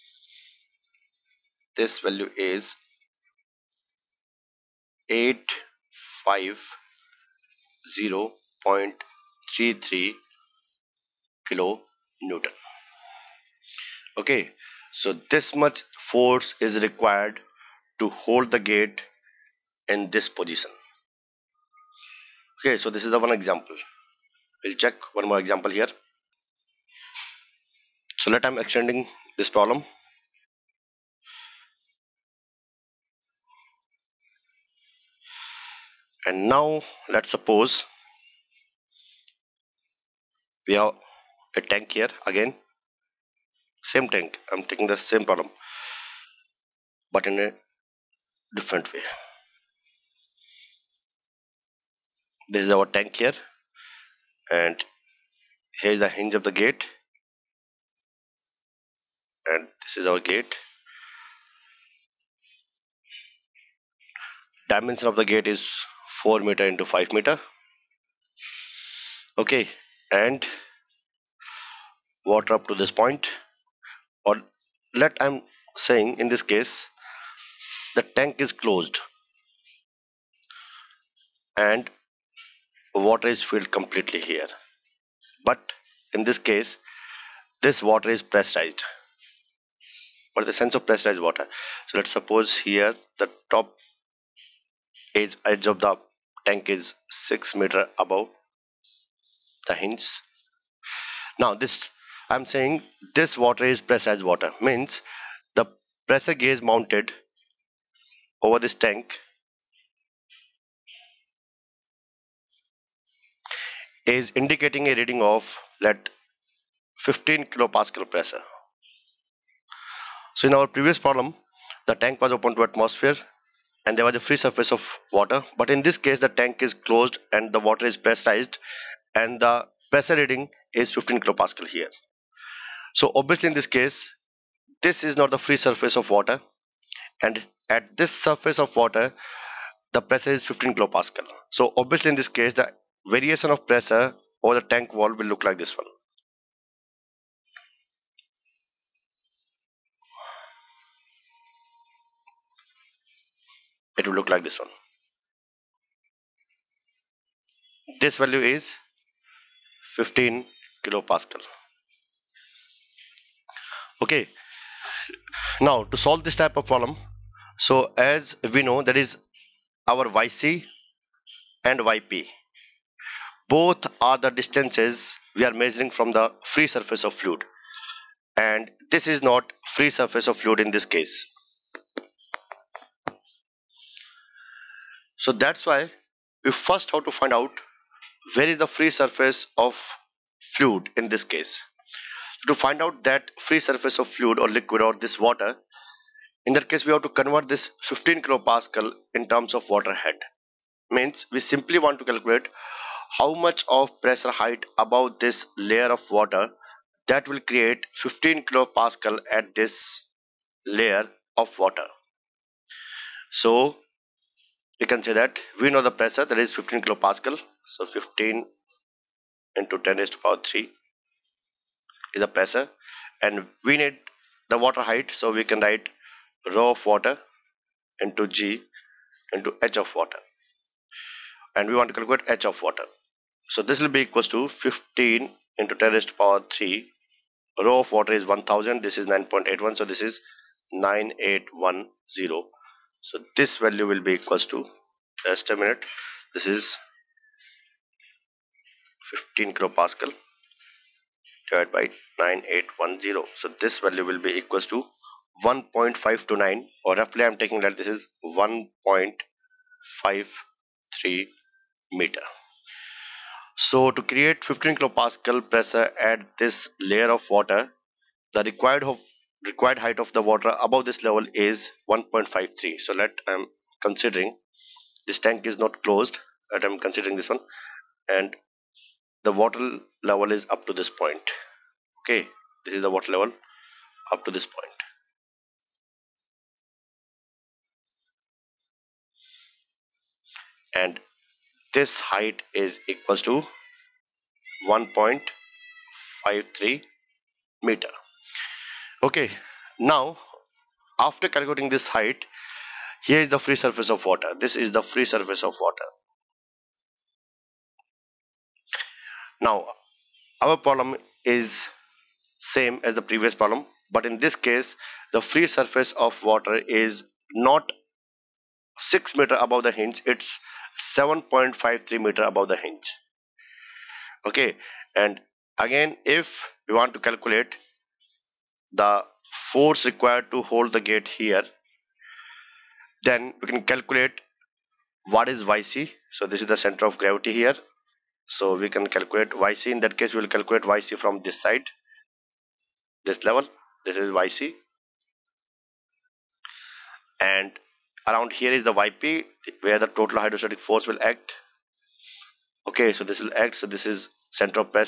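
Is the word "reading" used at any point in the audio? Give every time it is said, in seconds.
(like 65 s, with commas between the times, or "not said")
114 s, 130 s.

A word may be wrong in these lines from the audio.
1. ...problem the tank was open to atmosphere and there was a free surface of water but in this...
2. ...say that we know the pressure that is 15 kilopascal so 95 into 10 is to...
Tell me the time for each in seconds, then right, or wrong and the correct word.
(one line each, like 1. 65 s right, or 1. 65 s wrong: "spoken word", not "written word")
1. 120 s right
2. 215 s wrong: "15", not "95".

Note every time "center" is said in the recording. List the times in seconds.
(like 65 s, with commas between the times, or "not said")
336 s, 354 s.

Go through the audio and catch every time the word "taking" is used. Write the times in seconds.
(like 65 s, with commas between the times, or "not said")
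44 s, 257 s.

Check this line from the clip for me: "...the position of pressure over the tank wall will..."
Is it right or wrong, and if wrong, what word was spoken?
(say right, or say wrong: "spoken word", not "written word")
wrong: "variation", not "position".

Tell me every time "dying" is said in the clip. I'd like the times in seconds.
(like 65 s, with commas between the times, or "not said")
not said.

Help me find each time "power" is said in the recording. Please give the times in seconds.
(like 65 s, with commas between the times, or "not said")
220 s, 236 s.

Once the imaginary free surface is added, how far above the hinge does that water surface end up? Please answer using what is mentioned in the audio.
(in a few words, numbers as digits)
7.53 meters.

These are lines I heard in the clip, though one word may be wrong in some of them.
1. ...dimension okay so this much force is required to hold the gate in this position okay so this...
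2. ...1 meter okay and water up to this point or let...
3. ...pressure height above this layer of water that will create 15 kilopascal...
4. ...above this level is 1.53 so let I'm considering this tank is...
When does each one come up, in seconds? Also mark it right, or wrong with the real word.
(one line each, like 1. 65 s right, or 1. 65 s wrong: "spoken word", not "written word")
1. 12 s wrong: "newton", not "dimension"
2. 66 s wrong: "5", not "1"
3. 204 s right
4. 270 s right.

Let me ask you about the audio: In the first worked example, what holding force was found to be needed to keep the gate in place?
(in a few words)
850.33 kN.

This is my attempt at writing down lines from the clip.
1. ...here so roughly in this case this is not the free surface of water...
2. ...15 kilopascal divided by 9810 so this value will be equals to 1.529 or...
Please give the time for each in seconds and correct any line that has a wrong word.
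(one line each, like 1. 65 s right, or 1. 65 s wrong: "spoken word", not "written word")
1. 131 s wrong: "obviously", not "roughly"
2. 249 s right.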